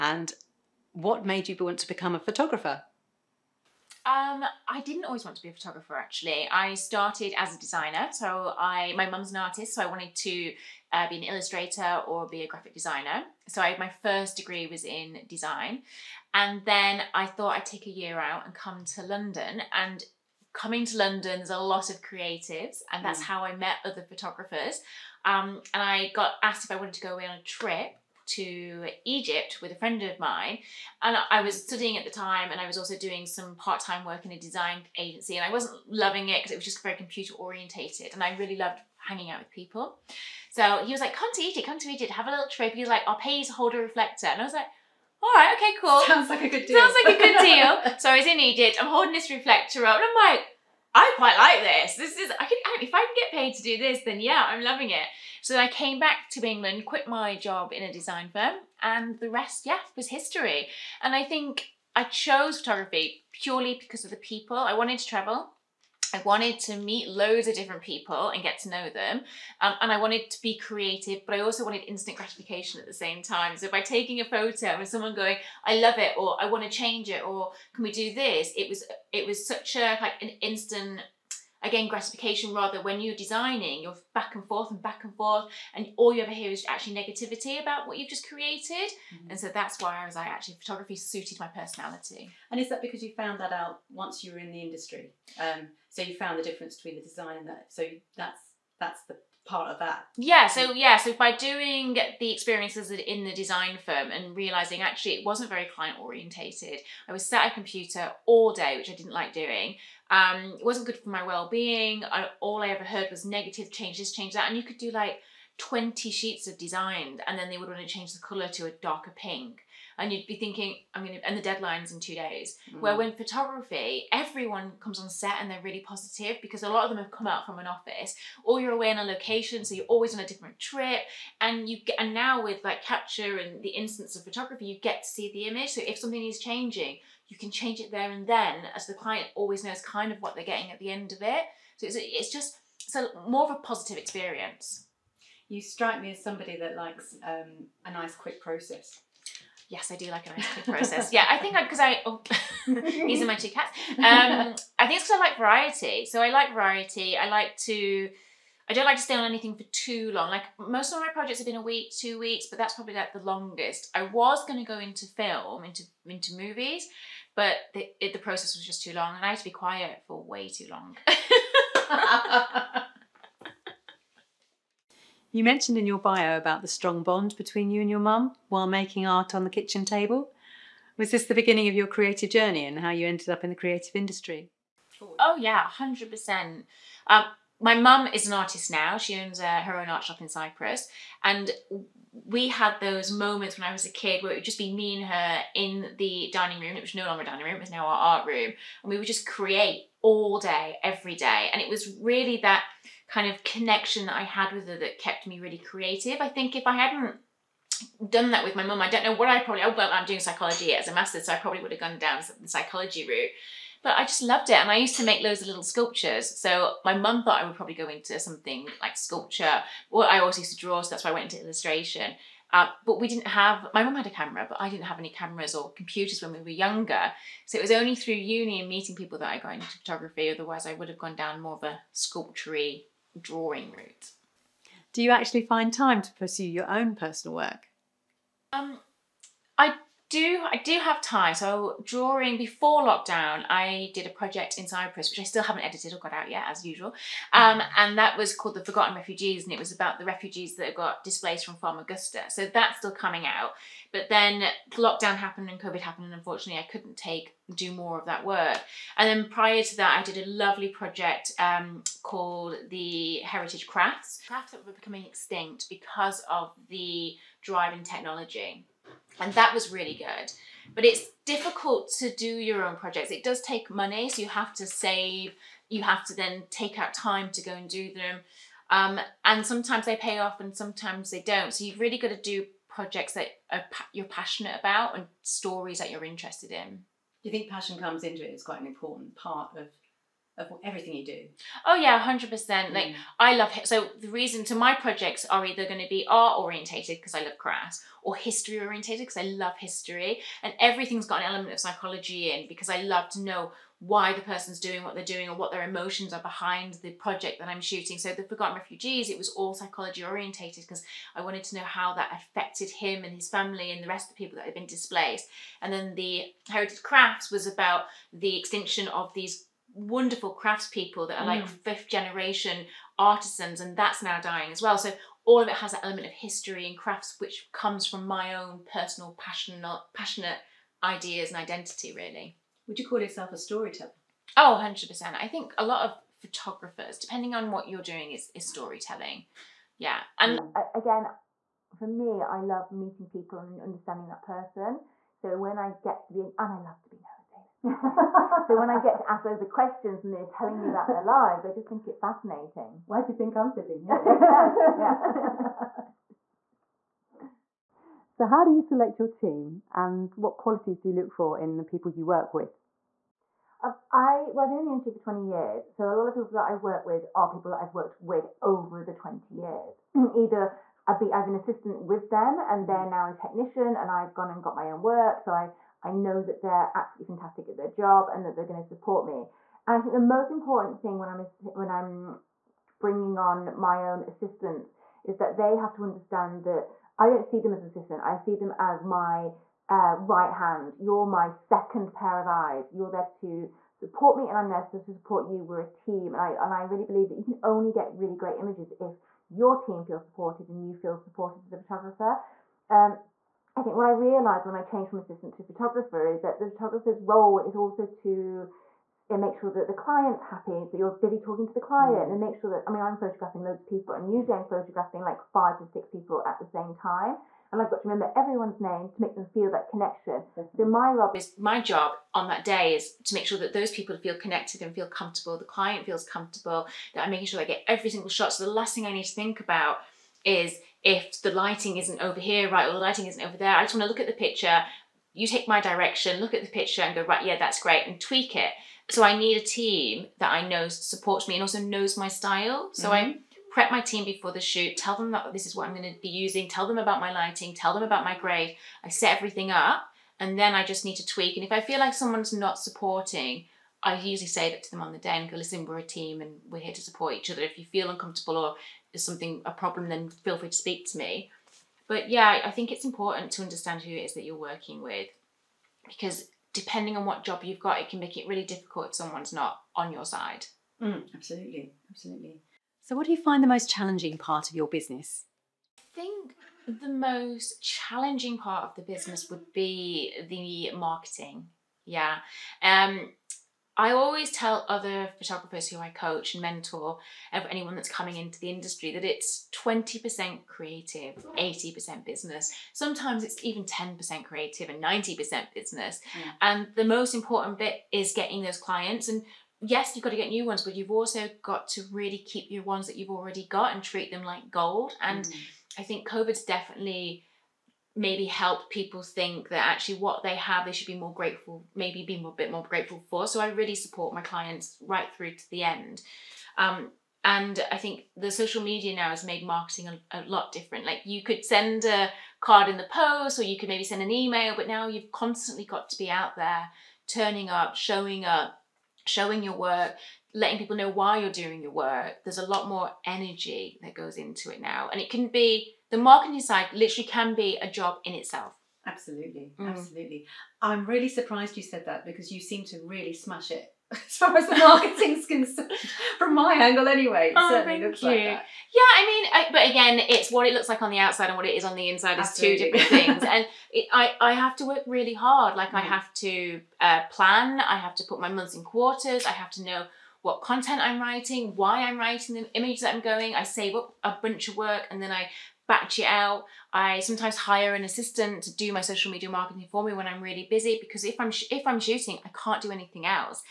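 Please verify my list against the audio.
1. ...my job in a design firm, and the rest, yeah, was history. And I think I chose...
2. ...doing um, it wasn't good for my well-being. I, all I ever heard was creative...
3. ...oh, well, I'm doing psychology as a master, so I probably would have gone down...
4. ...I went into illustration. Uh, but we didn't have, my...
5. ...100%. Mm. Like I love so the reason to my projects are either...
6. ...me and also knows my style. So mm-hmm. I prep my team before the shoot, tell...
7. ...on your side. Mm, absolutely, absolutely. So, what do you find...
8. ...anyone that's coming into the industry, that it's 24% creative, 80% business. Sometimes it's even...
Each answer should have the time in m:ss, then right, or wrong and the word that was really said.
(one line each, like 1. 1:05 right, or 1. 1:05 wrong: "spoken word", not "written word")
1. 0:57 right
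2. 1:49 wrong: "negative", not "creative"
3. 3:29 right
4. 3:41 right
5. 4:52 right
6. 7:21 right
7. 7:49 right
8. 8:07 wrong: "20", not "24".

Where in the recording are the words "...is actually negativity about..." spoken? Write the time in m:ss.
1:26.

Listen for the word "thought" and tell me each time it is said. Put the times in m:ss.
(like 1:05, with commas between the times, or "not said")
0:17, 3:37.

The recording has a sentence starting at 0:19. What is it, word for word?
And coming to London, there's a lot of creatives, and that's mm.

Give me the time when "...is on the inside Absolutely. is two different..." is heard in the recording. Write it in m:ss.
9:11.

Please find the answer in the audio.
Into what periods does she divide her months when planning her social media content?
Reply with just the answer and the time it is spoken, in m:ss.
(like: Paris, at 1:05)
Quarters, at 9:18.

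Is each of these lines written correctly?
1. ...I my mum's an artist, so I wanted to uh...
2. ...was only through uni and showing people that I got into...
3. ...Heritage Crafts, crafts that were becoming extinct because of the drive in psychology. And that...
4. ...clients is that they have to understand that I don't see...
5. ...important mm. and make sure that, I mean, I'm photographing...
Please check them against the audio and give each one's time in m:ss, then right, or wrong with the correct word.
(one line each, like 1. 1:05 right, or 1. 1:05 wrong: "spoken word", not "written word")
1. 0:08 right
2. 3:47 wrong: "meeting", not "showing"
3. 4:23 wrong: "technology", not "psychology"
4. 6:24 wrong: "assistants", not "clients"
5. 6:51 wrong: "client", not "important".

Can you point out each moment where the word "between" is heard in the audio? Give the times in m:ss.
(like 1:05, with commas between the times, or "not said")
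1:36, 2:57.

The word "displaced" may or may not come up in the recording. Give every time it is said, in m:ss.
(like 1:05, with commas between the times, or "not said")
4:11, 5:14.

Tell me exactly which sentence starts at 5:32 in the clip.
Would you call yourself a storyteller?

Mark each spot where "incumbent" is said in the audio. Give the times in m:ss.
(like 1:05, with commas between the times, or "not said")
not said.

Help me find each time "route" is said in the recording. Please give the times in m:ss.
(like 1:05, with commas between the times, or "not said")
3:33, 3:53.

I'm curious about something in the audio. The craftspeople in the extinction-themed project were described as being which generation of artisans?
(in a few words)
Fifth generation.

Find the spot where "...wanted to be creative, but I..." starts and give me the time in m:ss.
1:09.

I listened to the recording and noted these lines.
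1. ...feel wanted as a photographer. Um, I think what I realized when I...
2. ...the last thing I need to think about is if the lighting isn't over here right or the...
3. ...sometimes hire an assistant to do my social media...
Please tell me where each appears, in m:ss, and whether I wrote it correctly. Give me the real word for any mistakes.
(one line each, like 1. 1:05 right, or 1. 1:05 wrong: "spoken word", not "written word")
1. 6:40 wrong: "supported", not "wanted"
2. 7:08 right
3. 9:26 right.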